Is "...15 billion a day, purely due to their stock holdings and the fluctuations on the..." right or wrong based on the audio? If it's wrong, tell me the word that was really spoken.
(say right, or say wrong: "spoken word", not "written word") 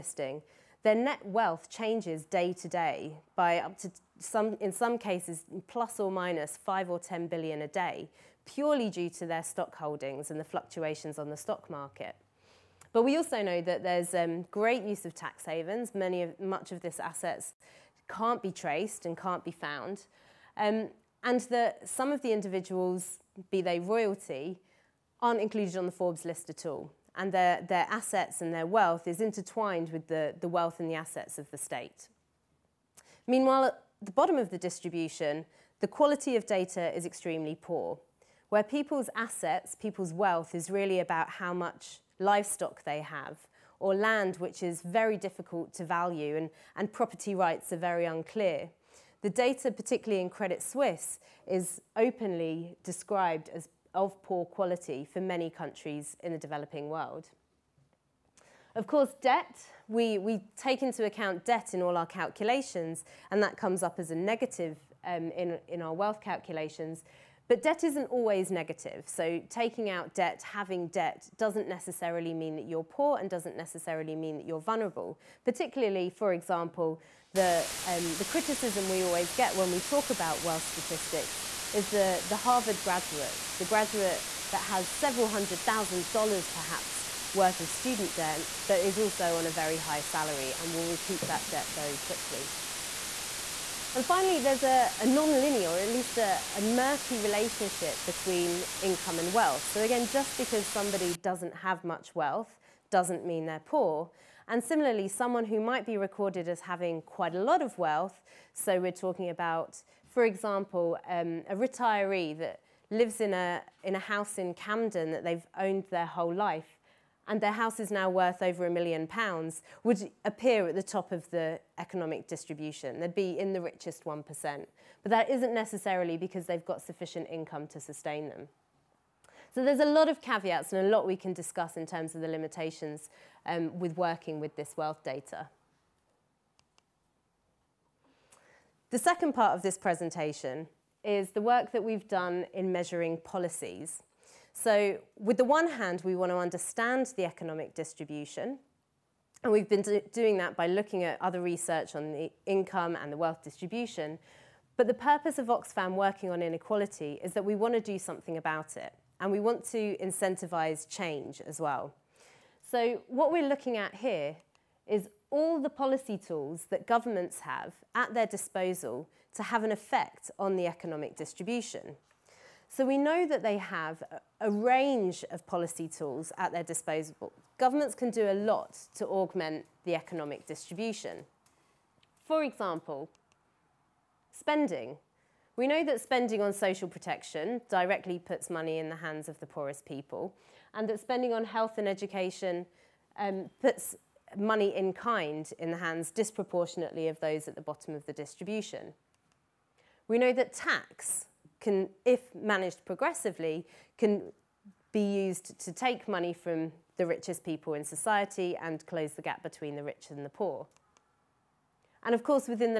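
wrong: "10", not "15".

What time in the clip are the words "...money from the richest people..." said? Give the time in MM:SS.
03:26.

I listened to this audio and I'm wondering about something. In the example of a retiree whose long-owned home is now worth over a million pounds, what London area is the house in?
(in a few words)
Camden.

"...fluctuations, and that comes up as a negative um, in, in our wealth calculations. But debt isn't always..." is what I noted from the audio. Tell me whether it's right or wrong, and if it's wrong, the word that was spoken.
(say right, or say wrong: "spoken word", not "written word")
wrong: "calculations", not "fluctuations".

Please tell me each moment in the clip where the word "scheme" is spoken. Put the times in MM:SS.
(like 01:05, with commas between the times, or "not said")
not said.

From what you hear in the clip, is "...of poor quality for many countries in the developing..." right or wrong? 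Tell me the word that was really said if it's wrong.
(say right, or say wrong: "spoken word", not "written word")
right.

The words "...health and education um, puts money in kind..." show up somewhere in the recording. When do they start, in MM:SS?
03:11.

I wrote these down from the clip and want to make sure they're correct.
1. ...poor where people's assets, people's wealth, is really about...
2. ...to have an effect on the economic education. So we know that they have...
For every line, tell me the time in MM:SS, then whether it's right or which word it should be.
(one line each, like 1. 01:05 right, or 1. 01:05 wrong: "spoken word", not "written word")
1. 00:37 right
2. 02:49 wrong: "distribution", not "education".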